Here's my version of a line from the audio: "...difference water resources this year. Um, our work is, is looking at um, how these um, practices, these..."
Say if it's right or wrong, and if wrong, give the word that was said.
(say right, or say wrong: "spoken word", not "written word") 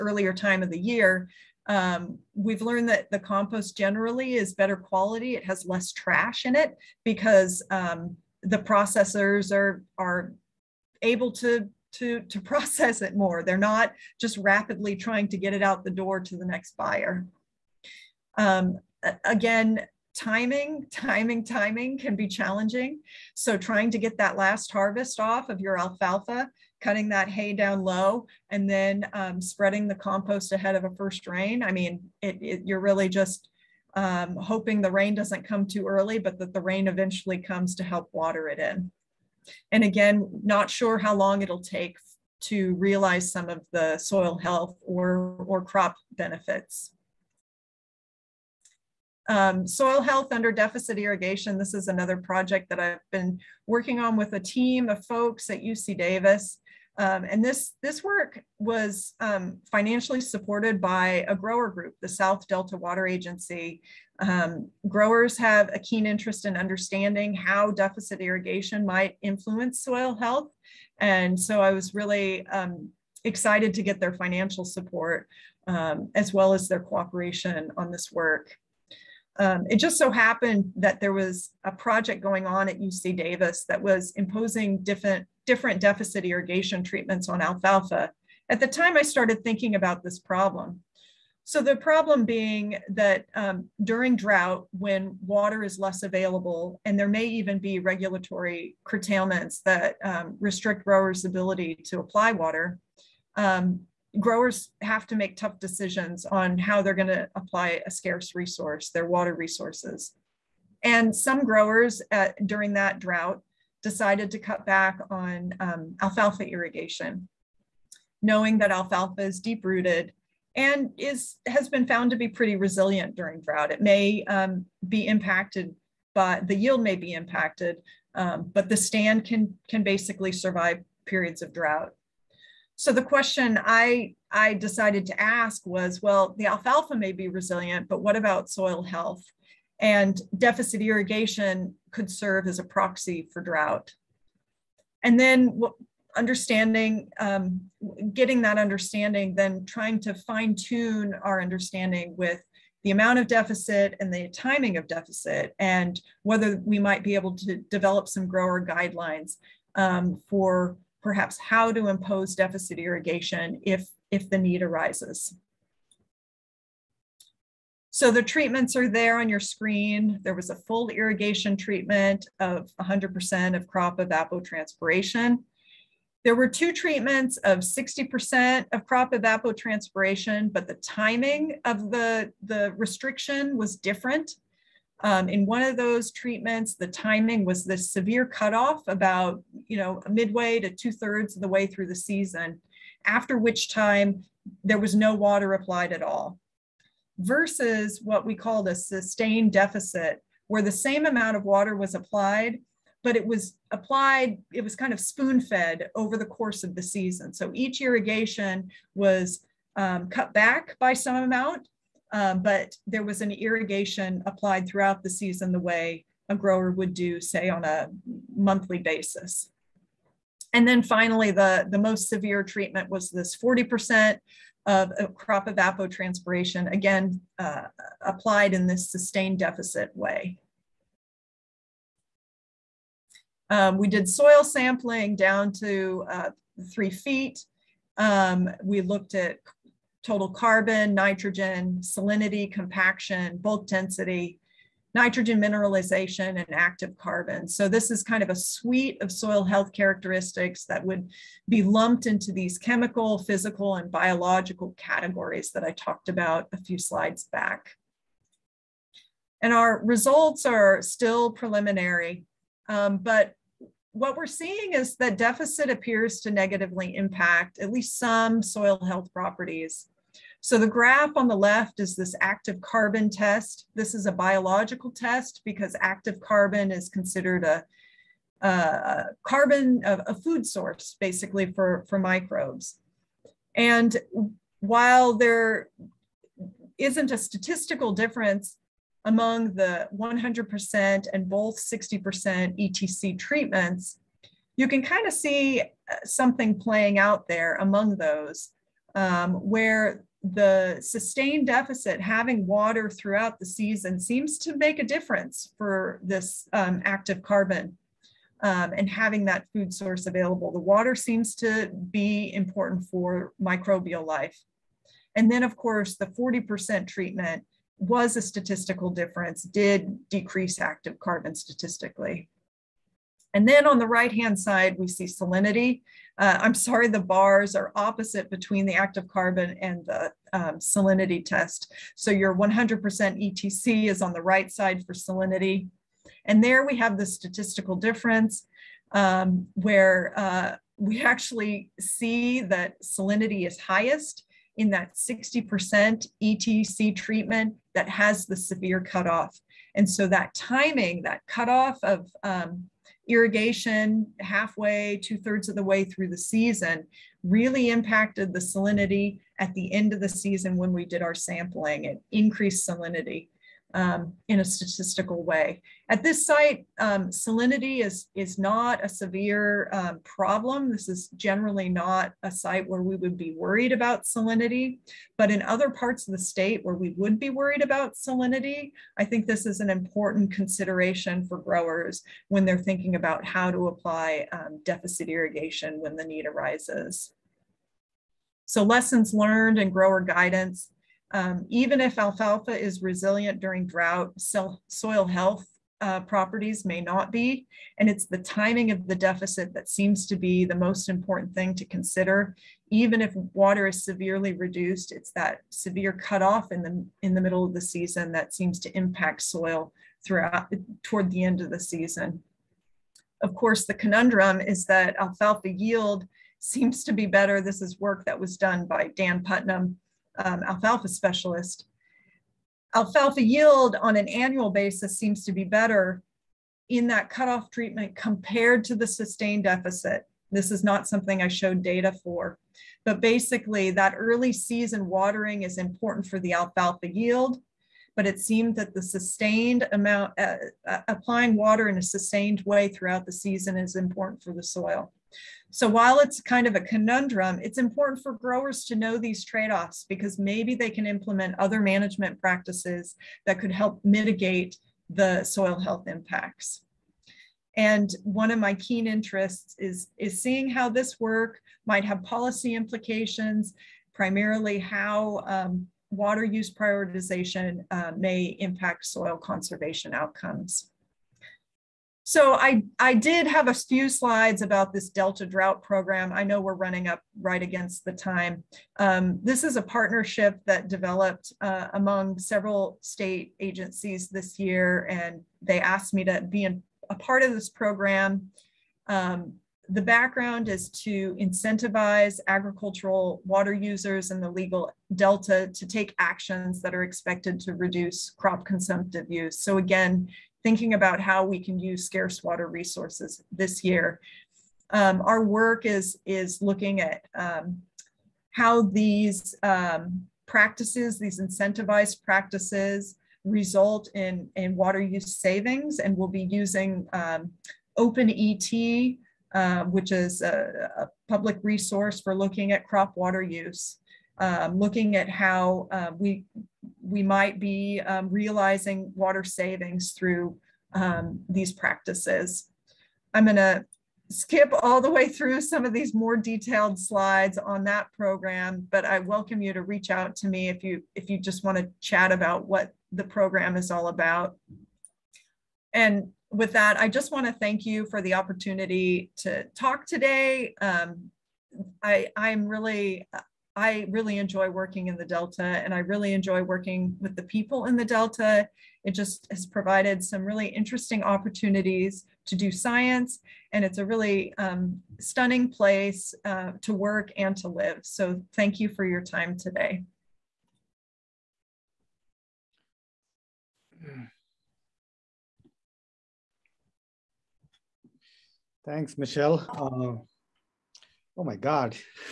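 wrong: "scarce", not "difference".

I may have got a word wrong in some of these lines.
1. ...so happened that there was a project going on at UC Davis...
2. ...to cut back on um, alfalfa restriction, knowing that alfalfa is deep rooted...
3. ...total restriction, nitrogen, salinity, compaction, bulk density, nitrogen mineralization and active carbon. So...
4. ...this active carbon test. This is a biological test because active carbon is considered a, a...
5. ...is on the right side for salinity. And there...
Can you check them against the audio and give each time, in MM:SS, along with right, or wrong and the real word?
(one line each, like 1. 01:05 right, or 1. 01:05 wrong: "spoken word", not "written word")
1. 01:19 right
2. 01:54 wrong: "irrigation", not "restriction"
3. 04:00 wrong: "carbon", not "restriction"
4. 04:31 right
5. 05:33 right.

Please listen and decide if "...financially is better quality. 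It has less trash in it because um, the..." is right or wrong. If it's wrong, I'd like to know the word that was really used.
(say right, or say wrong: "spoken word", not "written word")
wrong: "generally", not "financially".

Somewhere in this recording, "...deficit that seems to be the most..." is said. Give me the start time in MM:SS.
06:38.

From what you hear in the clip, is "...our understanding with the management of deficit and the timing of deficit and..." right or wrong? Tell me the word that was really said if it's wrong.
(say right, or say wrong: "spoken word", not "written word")
wrong: "amount", not "management".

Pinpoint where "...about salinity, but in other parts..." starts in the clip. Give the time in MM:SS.
06:13.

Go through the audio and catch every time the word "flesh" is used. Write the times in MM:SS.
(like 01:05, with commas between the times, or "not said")
not said.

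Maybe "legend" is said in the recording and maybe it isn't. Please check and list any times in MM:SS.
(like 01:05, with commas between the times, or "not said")
not said.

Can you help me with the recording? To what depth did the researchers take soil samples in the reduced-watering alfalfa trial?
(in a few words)
3 feet.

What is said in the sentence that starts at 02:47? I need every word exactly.
So the treatments are there on your screen.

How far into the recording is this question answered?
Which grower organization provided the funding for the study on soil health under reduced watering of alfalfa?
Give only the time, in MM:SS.
01:02.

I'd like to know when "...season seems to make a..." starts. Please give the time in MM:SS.
05:03.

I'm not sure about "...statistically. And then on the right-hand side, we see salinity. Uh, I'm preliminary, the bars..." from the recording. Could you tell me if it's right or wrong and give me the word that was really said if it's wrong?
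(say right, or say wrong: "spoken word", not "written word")
wrong: "sorry", not "preliminary".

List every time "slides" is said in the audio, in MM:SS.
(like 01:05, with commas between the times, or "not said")
04:16, 07:53, 08:56.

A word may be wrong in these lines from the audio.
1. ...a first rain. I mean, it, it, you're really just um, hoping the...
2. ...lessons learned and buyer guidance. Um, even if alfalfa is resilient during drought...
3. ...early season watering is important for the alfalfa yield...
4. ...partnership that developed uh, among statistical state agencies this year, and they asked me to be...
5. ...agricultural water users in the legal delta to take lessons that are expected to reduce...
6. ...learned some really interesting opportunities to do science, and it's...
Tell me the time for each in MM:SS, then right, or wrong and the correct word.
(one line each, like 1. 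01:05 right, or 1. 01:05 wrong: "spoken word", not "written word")
1. 00:30 right
2. 06:28 wrong: "grower", not "buyer"
3. 07:13 right
4. 07:59 wrong: "several", not "statistical"
5. 08:12 wrong: "actions", not "lessons"
6. 09:19 wrong: "provided", not "learned".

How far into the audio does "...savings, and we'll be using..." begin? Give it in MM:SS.
08:35.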